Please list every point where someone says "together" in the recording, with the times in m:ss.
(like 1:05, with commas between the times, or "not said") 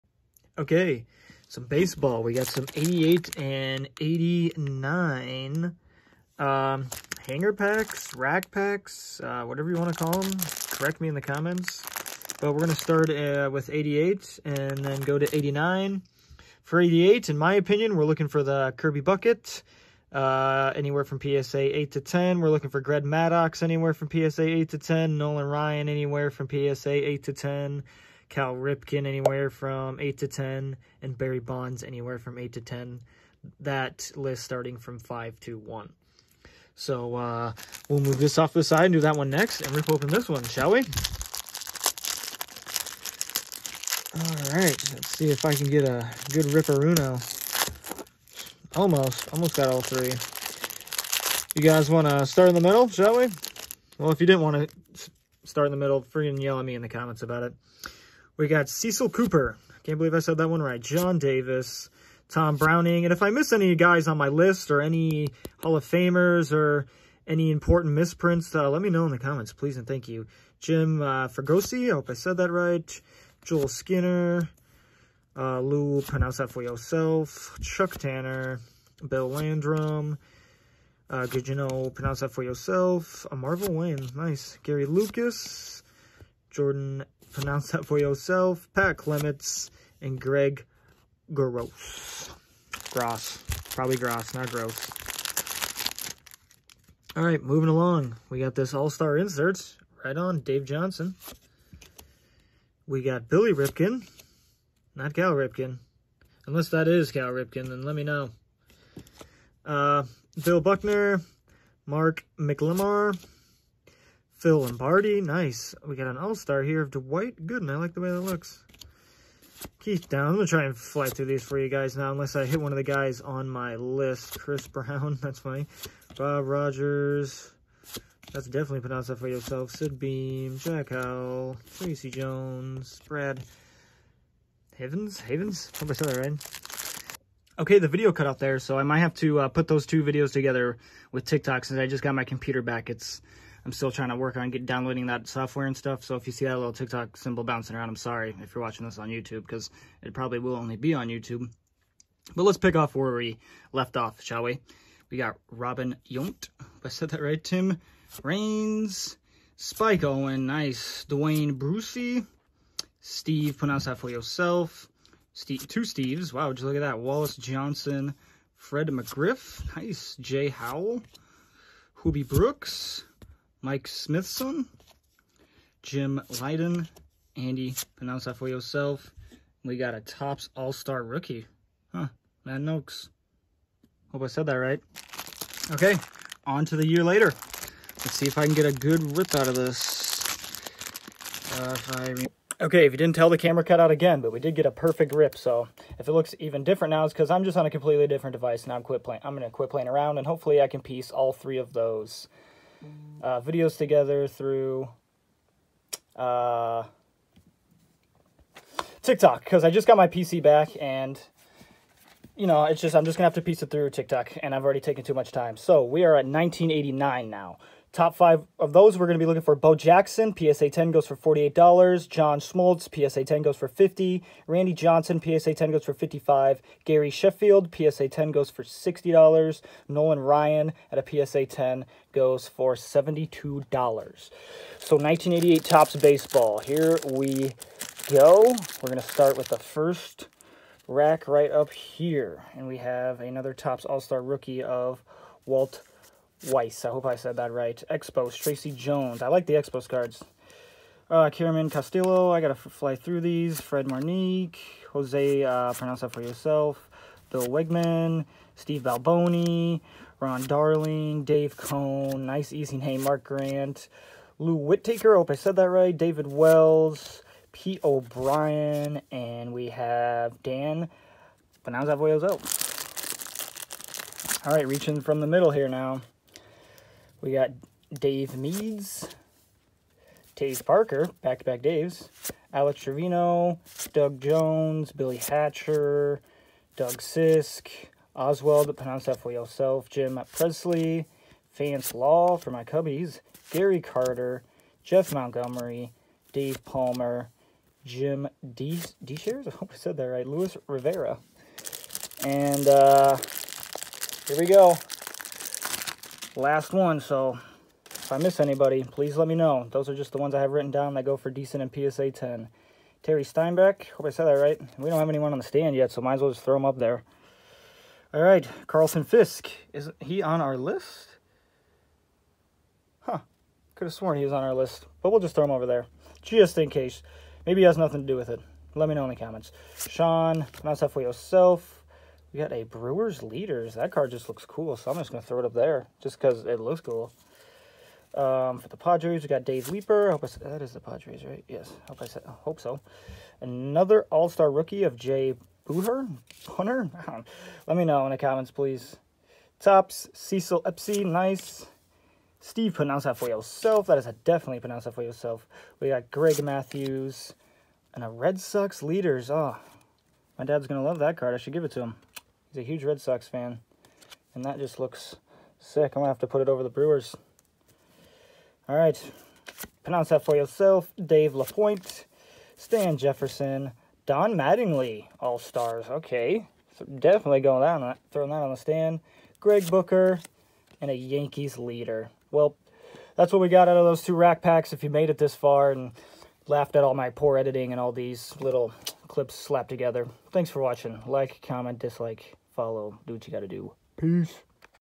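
2:20, 3:23, 6:29.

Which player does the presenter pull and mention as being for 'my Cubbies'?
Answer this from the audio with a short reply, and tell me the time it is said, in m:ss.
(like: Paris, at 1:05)
Vance Law, at 4:51.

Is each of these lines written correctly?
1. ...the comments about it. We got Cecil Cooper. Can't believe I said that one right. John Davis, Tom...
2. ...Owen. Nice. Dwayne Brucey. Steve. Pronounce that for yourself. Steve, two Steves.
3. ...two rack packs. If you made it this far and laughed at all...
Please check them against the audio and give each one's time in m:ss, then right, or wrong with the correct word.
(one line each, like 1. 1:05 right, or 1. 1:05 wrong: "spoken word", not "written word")
1. 0:56 right
2. 2:40 right
3. 6:24 right.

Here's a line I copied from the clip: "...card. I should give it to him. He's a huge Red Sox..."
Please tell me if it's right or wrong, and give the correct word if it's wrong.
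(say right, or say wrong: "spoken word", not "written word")
right.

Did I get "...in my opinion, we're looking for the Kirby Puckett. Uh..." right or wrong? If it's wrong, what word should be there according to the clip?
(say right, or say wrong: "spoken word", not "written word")
right.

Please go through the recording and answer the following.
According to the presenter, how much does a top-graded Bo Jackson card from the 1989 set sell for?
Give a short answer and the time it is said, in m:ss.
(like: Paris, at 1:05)
$48, at 3:41.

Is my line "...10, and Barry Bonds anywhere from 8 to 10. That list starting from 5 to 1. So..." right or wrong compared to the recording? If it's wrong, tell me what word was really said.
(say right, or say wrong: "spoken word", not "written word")
right.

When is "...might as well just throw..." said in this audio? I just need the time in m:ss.
5:16.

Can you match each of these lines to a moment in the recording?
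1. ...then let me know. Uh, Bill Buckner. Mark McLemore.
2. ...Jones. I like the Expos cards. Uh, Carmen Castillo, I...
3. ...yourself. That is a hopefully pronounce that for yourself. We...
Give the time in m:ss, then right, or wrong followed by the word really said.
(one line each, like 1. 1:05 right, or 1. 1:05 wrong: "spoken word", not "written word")
1. 1:47 right
2. 4:08 right
3. 5:53 wrong: "definitely", not "hopefully".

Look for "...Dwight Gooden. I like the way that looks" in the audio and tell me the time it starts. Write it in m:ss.
1:56.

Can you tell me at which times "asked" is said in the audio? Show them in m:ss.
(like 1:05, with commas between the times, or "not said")
not said.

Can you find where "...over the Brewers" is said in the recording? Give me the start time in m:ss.
6:06.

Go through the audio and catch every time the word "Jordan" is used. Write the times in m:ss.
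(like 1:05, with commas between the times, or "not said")
1:26.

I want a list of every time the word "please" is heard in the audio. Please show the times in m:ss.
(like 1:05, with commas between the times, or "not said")
1:09, 5:08, 5:48.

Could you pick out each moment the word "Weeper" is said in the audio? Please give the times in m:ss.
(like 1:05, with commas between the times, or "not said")
5:39.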